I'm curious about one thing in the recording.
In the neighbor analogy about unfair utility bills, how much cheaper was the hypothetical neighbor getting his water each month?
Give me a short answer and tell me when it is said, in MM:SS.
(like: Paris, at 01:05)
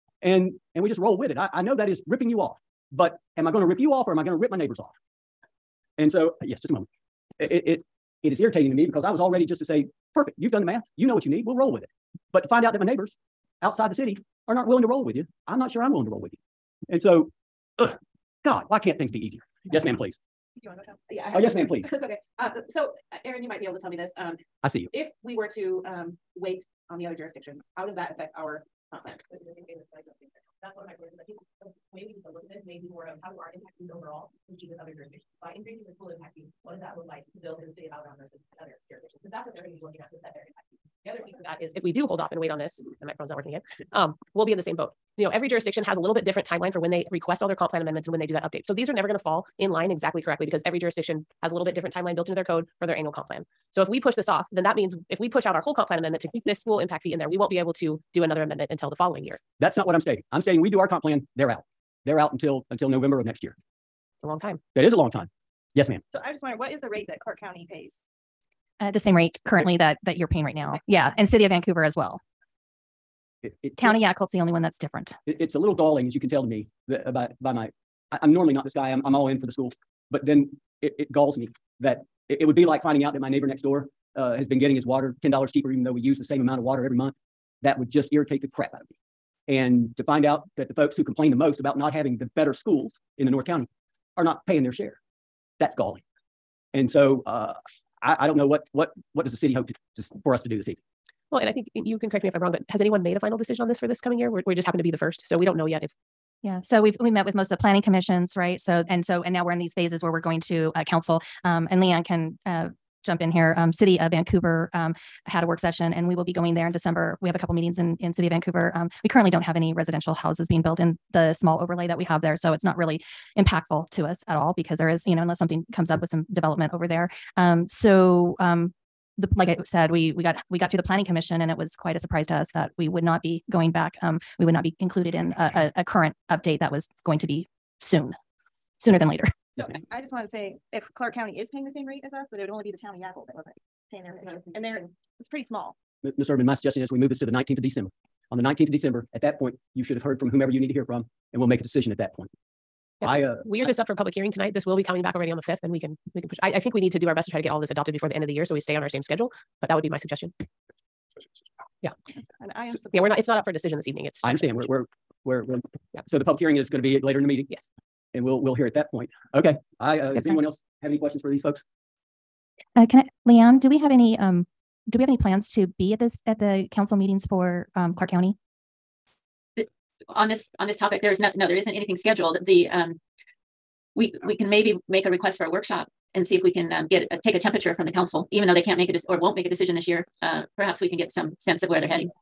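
$10, at 01:25.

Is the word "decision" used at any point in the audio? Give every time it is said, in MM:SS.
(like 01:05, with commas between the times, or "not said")
01:43, 02:31, 02:43, 03:09.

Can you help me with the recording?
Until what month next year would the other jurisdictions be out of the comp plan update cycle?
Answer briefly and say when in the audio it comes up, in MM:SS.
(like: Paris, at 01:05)
November, at 01:02.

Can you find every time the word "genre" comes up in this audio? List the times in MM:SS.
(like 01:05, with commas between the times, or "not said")
not said.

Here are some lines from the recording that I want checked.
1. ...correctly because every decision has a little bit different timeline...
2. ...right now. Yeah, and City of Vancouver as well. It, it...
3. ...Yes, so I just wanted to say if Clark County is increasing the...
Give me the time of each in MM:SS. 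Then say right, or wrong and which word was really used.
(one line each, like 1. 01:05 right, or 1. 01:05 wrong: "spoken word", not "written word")
1. 00:50 wrong: "jurisdiction", not "decision"
2. 01:10 right
3. 02:19 wrong: "paying", not "increasing".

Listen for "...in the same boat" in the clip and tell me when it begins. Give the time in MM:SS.
00:44.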